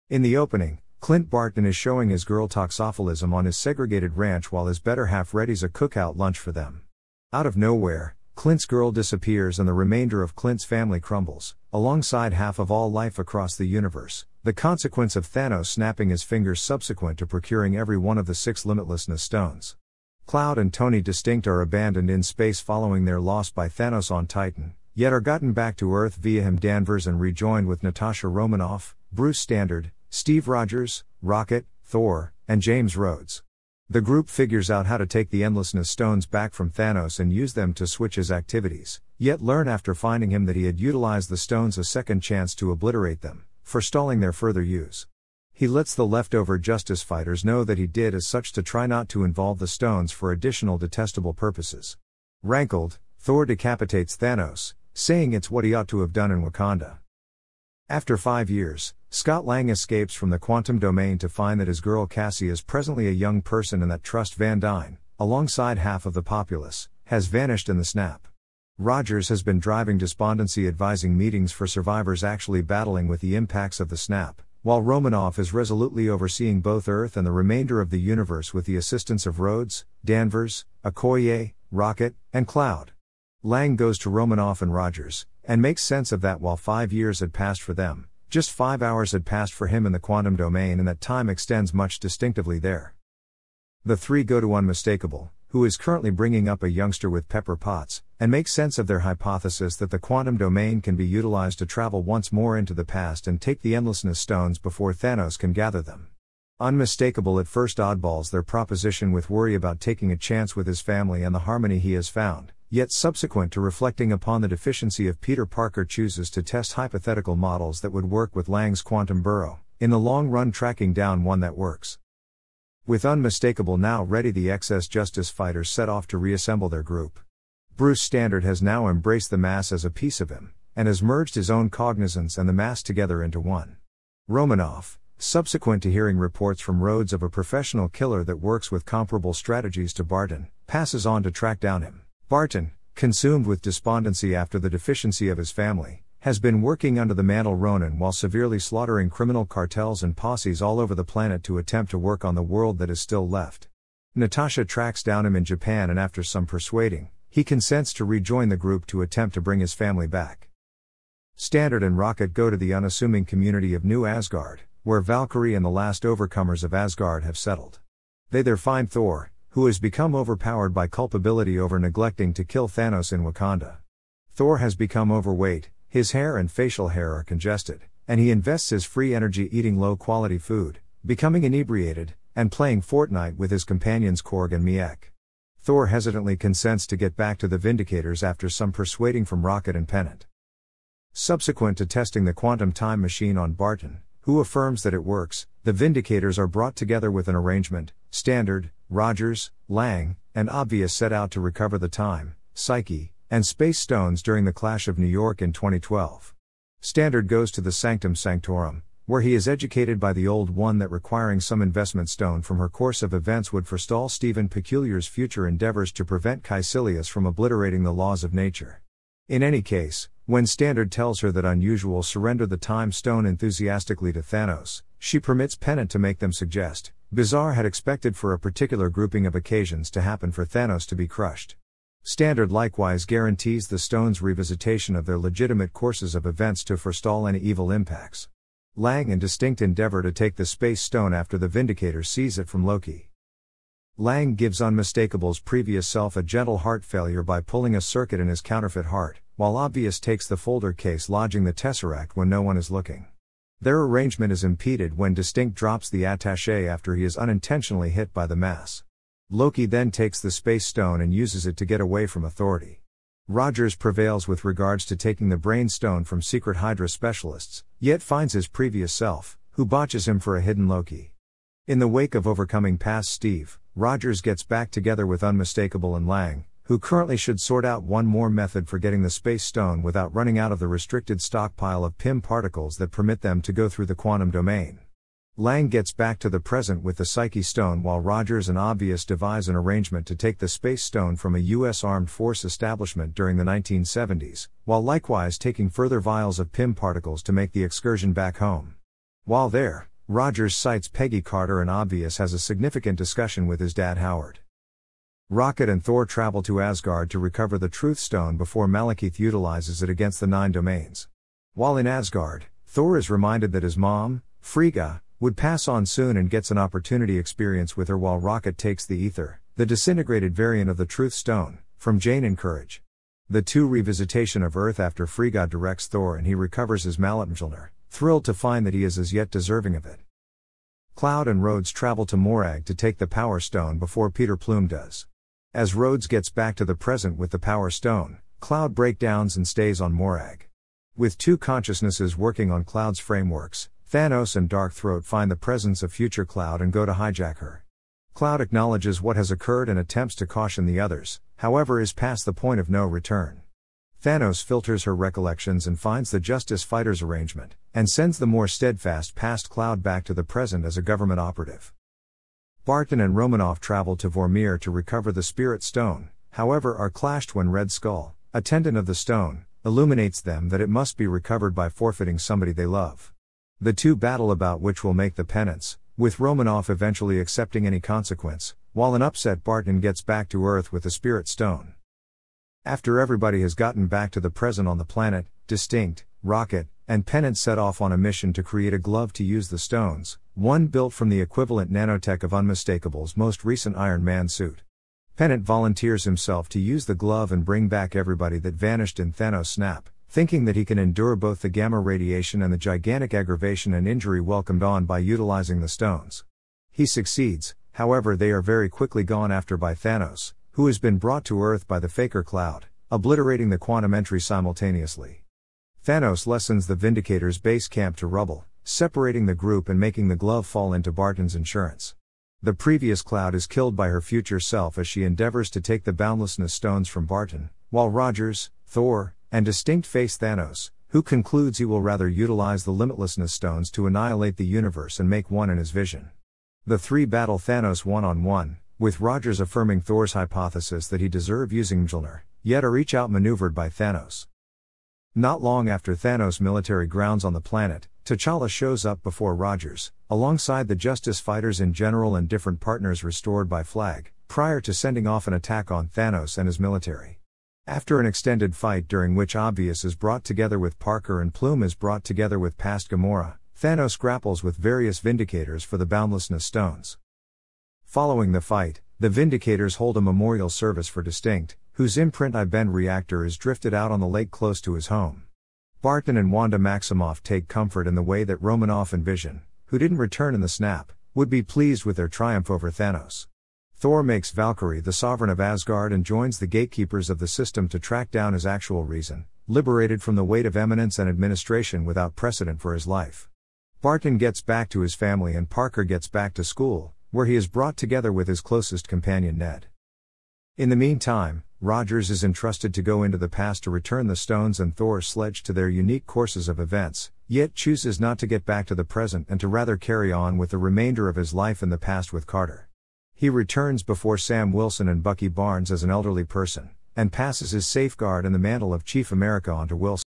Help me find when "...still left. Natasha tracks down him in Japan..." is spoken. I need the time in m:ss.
2:33.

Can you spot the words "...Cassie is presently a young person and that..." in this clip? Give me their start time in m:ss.
1:02.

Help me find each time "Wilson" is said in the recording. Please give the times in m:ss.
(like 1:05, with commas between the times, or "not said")
8:34, 8:39.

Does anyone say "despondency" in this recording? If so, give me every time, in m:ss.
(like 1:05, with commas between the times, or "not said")
1:09, 2:23.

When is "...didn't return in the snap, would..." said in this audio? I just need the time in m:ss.
7:59.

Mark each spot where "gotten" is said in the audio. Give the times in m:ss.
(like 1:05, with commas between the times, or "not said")
0:25, 6:23.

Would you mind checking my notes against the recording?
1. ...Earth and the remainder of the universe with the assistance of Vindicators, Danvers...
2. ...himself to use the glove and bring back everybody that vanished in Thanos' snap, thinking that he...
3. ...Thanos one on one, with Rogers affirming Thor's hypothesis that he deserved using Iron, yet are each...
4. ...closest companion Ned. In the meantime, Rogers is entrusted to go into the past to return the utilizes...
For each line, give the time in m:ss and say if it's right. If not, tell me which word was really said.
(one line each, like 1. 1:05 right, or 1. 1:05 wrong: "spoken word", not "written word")
1. 1:16 wrong: "Rhodes", not "Vindicators"
2. 6:36 right
3. 7:17 wrong: "Mjolnir", not "Iron"
4. 8:18 wrong: "stones", not "utilizes".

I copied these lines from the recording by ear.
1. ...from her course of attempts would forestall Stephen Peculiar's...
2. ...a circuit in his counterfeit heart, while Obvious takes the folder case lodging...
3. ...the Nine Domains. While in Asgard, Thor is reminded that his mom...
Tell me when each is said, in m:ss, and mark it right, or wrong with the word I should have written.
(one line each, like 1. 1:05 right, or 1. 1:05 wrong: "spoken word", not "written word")
1. 3:32 wrong: "events", not "attempts"
2. 4:07 right
3. 5:10 right.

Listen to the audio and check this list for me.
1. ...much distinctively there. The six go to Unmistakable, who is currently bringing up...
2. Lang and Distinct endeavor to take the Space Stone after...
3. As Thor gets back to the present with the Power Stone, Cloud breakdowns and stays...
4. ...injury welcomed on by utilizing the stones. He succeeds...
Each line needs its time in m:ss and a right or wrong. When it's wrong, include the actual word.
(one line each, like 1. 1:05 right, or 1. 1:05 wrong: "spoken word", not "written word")
1. 1:31 wrong: "three", not "six"
2. 3:58 right
3. 5:35 wrong: "Rhodes", not "Thor"
4. 6:43 right.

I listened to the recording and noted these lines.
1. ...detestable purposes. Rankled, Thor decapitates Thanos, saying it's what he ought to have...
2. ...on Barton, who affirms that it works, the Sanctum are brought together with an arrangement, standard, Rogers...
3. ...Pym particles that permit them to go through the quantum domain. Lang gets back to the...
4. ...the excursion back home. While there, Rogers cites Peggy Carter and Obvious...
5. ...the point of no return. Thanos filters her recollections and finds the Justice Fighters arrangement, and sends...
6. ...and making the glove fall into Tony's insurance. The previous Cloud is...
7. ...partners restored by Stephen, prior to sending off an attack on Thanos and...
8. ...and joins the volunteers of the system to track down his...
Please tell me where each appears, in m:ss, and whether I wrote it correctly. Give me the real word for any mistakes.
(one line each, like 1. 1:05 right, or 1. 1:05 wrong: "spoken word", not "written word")
1. 0:50 right
2. 3:13 wrong: "Vindicators", not "Sanctum"
3. 4:41 right
4. 4:57 right
5. 5:52 right
6. 6:59 wrong: "Barton", not "Tony"
7. 7:32 wrong: "Flag", not "Stephen"
8. 8:05 wrong: "gatekeepers", not "volunteers".